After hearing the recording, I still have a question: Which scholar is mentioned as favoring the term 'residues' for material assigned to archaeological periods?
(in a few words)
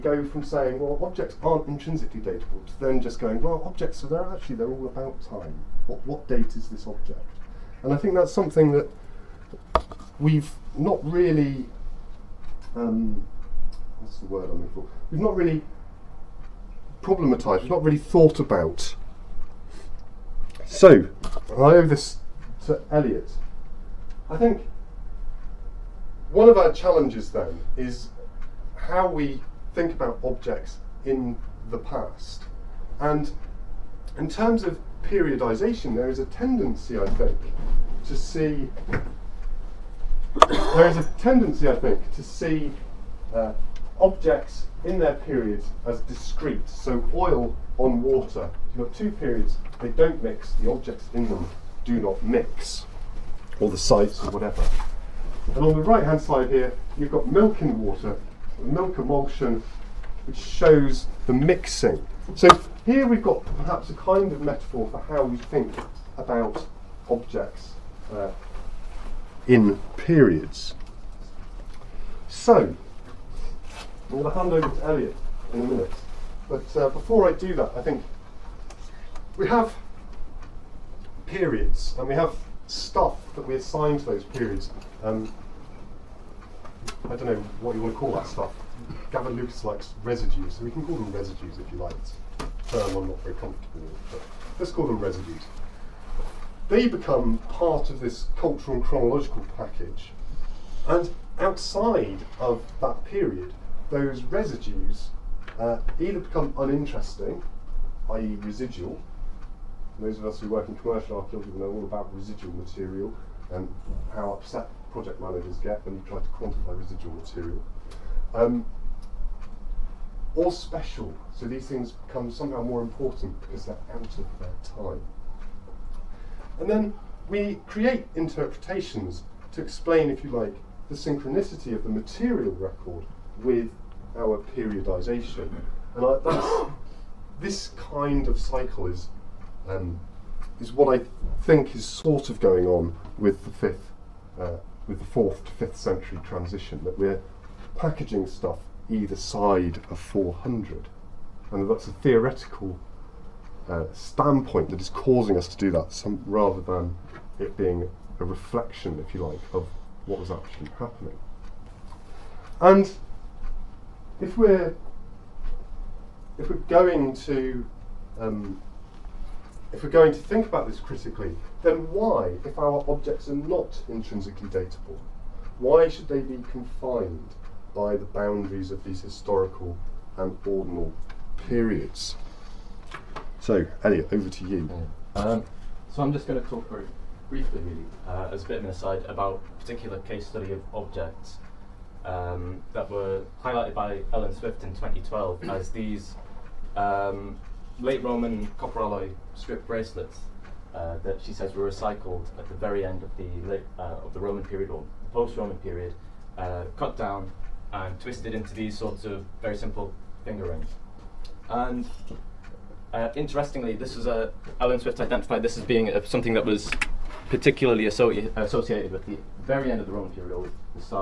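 Gavin Lucas.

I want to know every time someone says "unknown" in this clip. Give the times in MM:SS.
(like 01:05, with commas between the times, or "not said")
not said.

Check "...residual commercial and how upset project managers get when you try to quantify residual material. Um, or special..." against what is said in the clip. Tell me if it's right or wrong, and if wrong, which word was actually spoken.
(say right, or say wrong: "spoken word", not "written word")
wrong: "material", not "commercial".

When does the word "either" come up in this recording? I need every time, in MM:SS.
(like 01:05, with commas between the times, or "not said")
01:45, 02:28.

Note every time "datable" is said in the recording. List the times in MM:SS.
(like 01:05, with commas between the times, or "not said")
00:02, 02:54.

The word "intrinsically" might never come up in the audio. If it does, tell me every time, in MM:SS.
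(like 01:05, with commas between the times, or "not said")
00:01, 02:53.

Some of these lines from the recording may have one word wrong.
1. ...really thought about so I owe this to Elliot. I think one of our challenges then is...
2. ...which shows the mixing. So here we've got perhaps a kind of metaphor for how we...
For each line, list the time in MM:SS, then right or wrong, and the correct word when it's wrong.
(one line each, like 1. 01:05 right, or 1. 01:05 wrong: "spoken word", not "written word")
1. 00:17 right
2. 01:00 right.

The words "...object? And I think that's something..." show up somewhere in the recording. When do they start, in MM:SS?
00:06.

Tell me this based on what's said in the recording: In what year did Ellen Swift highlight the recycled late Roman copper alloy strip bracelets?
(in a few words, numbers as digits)
2012.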